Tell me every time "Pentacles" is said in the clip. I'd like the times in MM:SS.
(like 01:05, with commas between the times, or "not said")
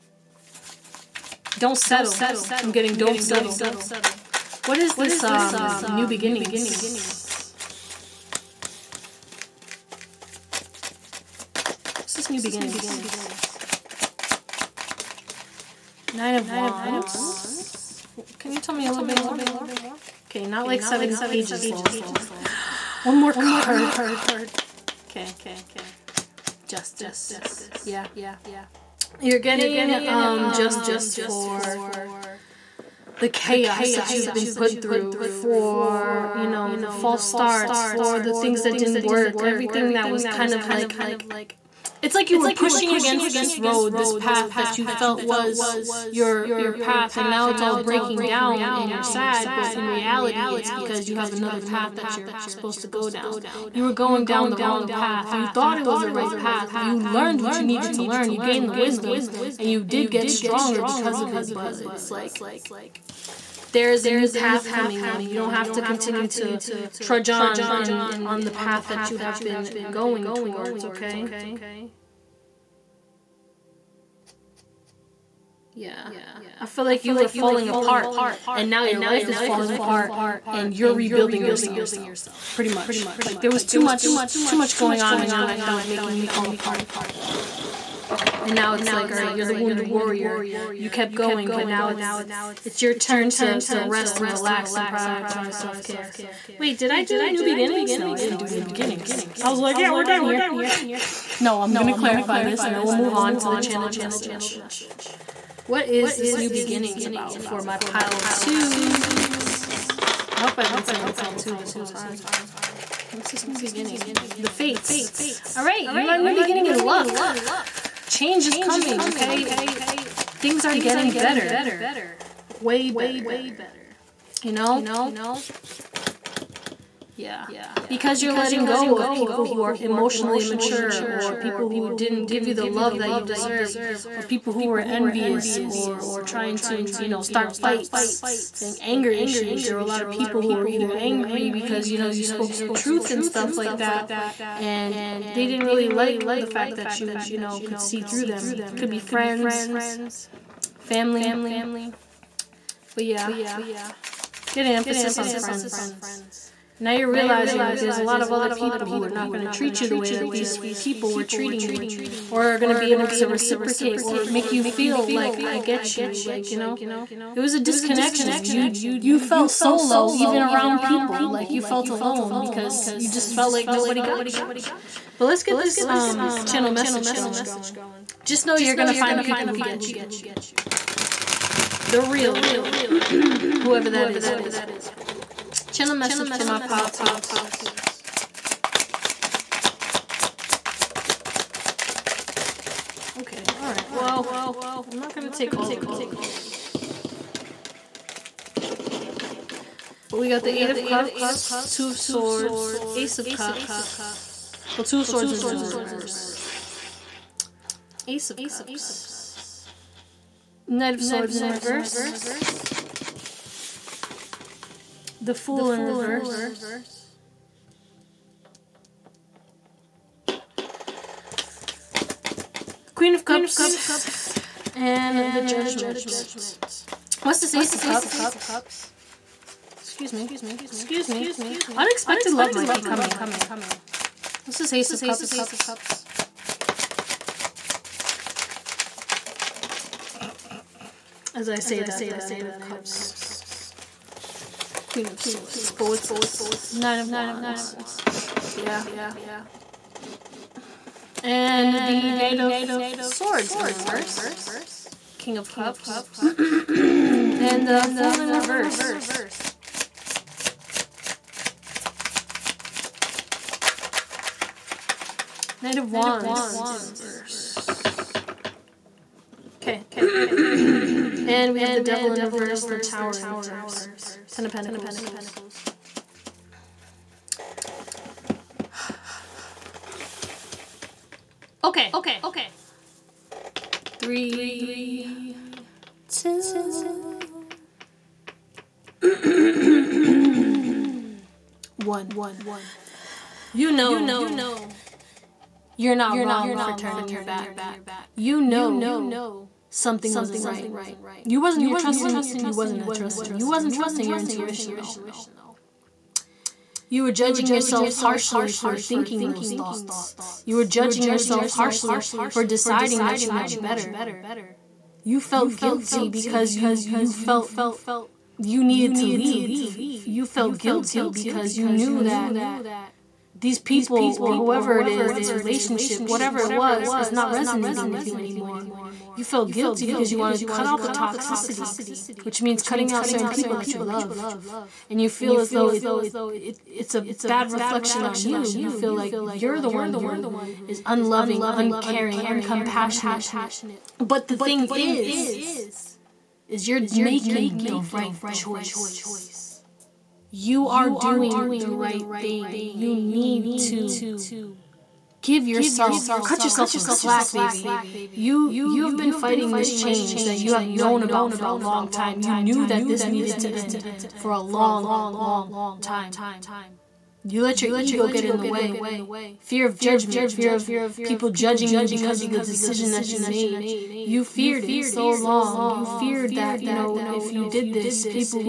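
04:34.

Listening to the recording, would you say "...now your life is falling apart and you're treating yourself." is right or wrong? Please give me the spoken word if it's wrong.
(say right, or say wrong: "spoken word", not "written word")
wrong: "rebuilding", not "treating".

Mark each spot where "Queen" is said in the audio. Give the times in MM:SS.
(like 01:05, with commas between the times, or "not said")
03:42, 04:04.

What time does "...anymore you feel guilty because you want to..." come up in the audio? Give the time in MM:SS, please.
05:28.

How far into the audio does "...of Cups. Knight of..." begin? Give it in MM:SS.
03:28.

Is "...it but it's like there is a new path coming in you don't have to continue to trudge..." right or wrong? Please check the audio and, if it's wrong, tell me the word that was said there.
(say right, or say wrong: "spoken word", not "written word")
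right.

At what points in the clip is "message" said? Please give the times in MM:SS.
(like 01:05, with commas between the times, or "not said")
01:43, 02:56, 03:05.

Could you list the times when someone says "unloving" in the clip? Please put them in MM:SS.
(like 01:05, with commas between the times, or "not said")
05:40.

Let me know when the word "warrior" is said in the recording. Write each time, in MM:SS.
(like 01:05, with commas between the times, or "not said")
01:29.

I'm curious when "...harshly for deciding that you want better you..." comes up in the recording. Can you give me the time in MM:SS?
05:11.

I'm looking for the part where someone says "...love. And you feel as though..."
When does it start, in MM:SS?
05:33.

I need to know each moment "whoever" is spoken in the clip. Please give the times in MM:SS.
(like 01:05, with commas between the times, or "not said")
03:03, 05:24.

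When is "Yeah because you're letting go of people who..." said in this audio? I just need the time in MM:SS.
02:07.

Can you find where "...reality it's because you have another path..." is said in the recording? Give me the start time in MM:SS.
00:49.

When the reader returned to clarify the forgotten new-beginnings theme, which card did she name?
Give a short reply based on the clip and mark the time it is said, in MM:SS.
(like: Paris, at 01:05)
The Fates, at 01:54.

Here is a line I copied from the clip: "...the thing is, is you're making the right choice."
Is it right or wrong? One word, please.
right.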